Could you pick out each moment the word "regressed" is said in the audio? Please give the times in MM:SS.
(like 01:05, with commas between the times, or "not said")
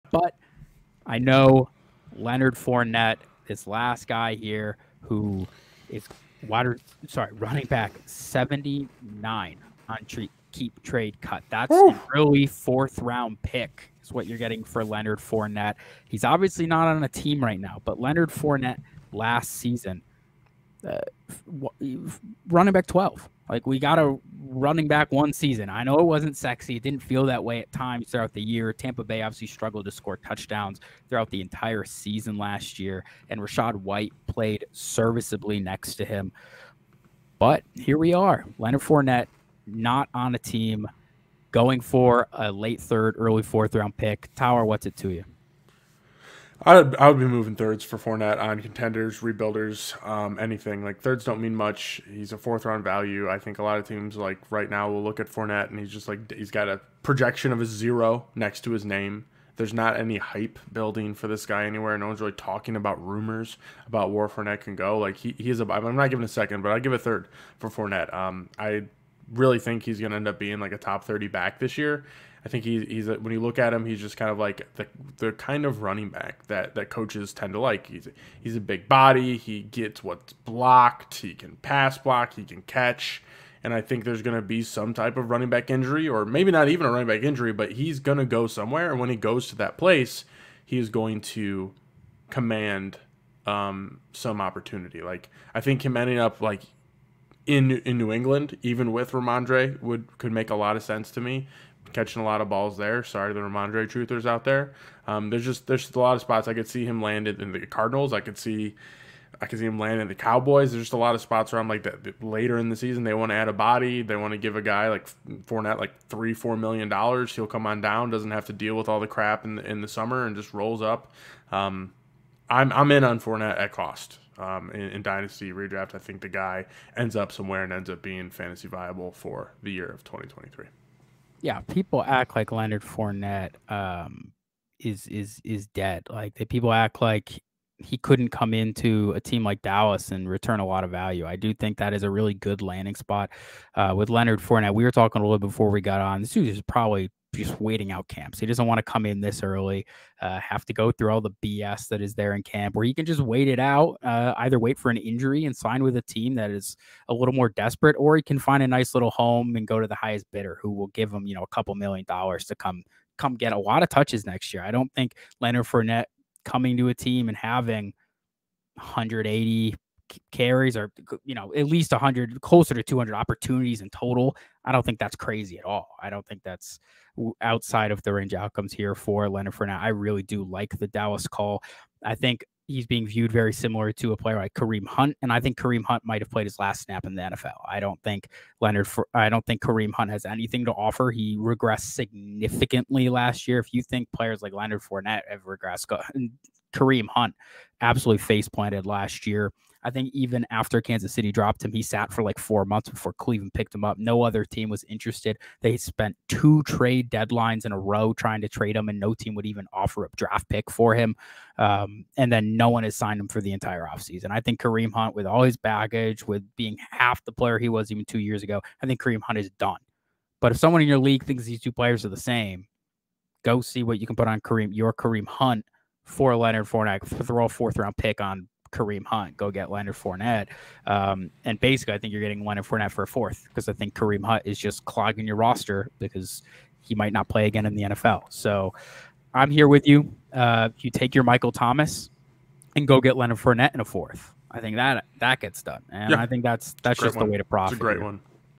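03:11, 03:15.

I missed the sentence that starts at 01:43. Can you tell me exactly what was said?
Sorry to the Rhamondre truthers out there.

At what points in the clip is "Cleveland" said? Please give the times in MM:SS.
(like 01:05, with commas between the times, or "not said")
03:23.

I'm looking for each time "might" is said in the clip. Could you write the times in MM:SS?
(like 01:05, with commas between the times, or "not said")
03:06, 03:56.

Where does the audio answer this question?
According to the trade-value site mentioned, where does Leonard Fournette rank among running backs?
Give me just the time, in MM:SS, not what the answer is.
00:08.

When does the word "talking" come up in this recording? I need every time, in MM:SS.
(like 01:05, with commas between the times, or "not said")
01:02, 02:24.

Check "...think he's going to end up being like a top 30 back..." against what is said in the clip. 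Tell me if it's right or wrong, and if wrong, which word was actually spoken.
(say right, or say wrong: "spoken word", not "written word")
right.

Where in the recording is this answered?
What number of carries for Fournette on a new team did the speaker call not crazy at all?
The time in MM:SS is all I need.
02:48.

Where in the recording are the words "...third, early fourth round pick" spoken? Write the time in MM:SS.
00:42.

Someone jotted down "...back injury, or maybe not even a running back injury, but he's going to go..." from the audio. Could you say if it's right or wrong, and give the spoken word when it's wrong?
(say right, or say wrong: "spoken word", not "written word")
right.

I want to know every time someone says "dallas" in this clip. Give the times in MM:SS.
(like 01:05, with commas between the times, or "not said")
02:19, 03:00.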